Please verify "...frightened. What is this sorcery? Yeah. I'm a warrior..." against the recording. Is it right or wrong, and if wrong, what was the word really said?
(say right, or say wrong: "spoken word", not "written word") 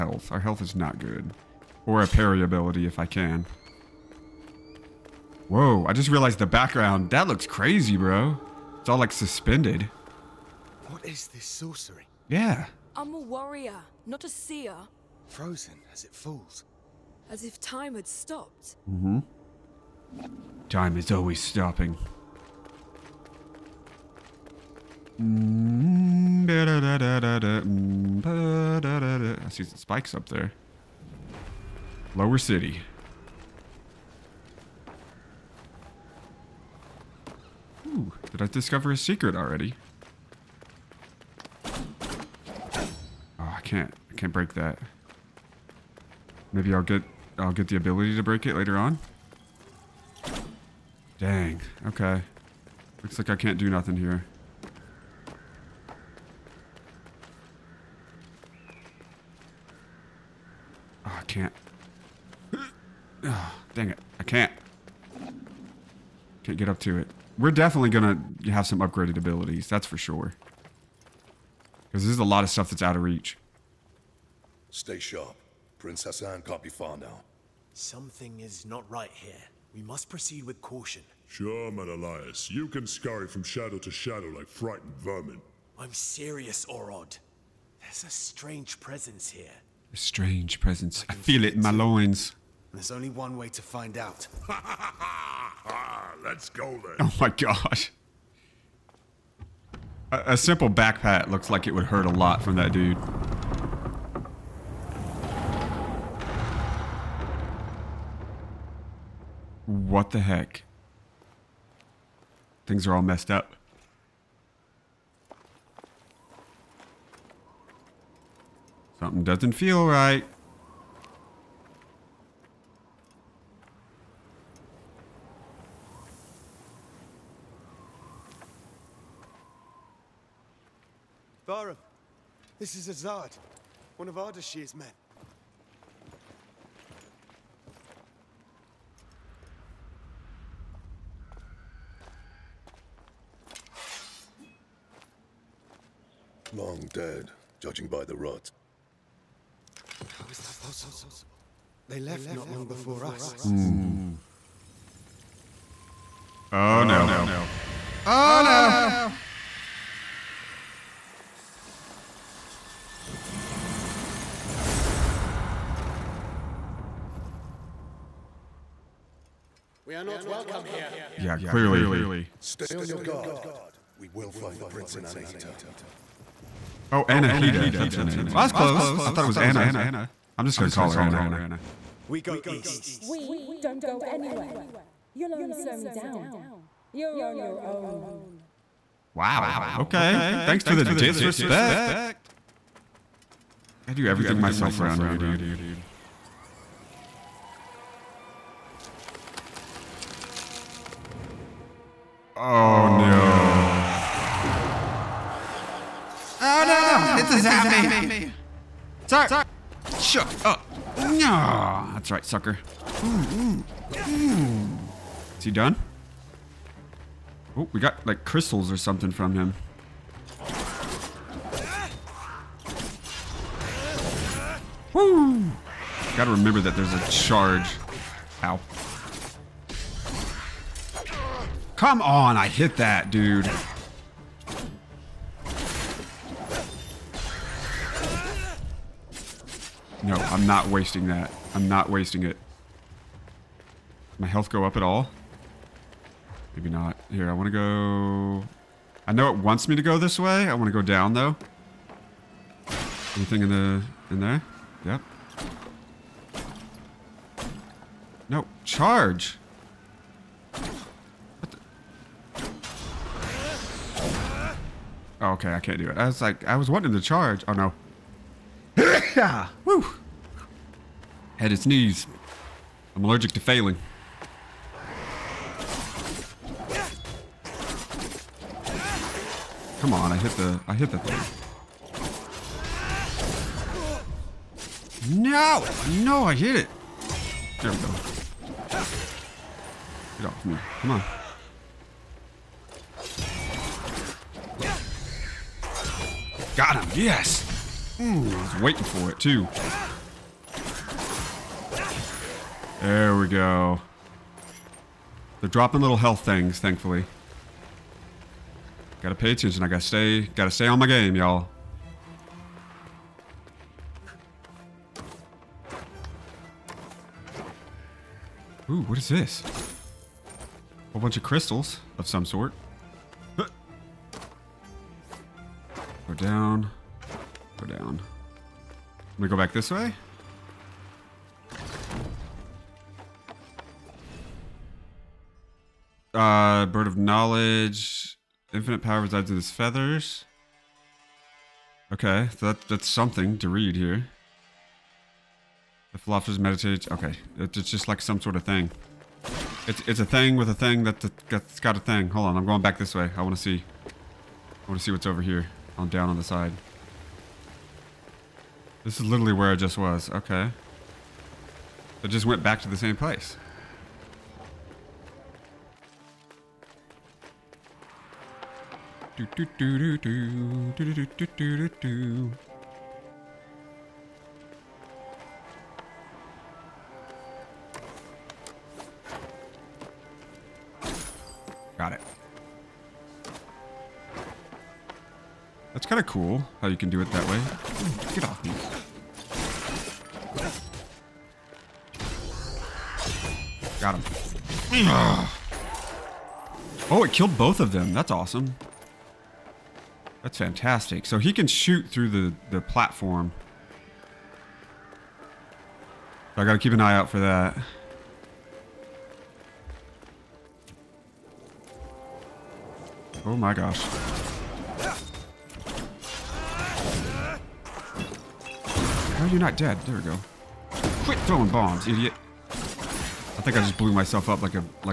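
wrong: "suspended", not "frightened".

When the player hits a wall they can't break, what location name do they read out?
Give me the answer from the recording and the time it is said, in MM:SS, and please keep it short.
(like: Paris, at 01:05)
Lower City, at 00:32.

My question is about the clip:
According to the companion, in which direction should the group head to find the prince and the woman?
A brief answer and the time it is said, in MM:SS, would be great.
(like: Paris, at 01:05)
east, at 03:02.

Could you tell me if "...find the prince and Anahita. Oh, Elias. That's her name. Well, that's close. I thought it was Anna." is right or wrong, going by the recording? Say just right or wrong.
wrong.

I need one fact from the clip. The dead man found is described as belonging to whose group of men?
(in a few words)
Ardashir.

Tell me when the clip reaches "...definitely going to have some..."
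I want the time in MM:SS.
01:07.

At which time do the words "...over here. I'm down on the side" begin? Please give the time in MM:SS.
05:55.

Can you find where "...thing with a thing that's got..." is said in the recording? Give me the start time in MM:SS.
05:50.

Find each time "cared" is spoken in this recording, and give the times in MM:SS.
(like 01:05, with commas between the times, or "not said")
not said.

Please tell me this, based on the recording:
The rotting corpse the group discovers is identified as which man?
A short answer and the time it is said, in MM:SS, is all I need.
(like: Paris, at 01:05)
Azad, at 02:12.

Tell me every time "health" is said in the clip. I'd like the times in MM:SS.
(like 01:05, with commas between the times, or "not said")
00:00, 04:04, 05:05.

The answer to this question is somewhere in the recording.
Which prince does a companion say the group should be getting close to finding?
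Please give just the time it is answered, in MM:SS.
01:15.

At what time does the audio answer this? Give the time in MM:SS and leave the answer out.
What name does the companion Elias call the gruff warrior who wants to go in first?
01:26.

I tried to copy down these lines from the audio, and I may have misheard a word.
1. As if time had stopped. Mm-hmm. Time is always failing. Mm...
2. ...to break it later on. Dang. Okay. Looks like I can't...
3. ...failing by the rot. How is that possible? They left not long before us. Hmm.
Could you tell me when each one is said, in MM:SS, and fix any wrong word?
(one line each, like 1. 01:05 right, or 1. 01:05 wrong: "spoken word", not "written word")
1. 00:17 wrong: "stopping", not "failing"
2. 00:48 right
3. 02:27 wrong: "judging", not "failing".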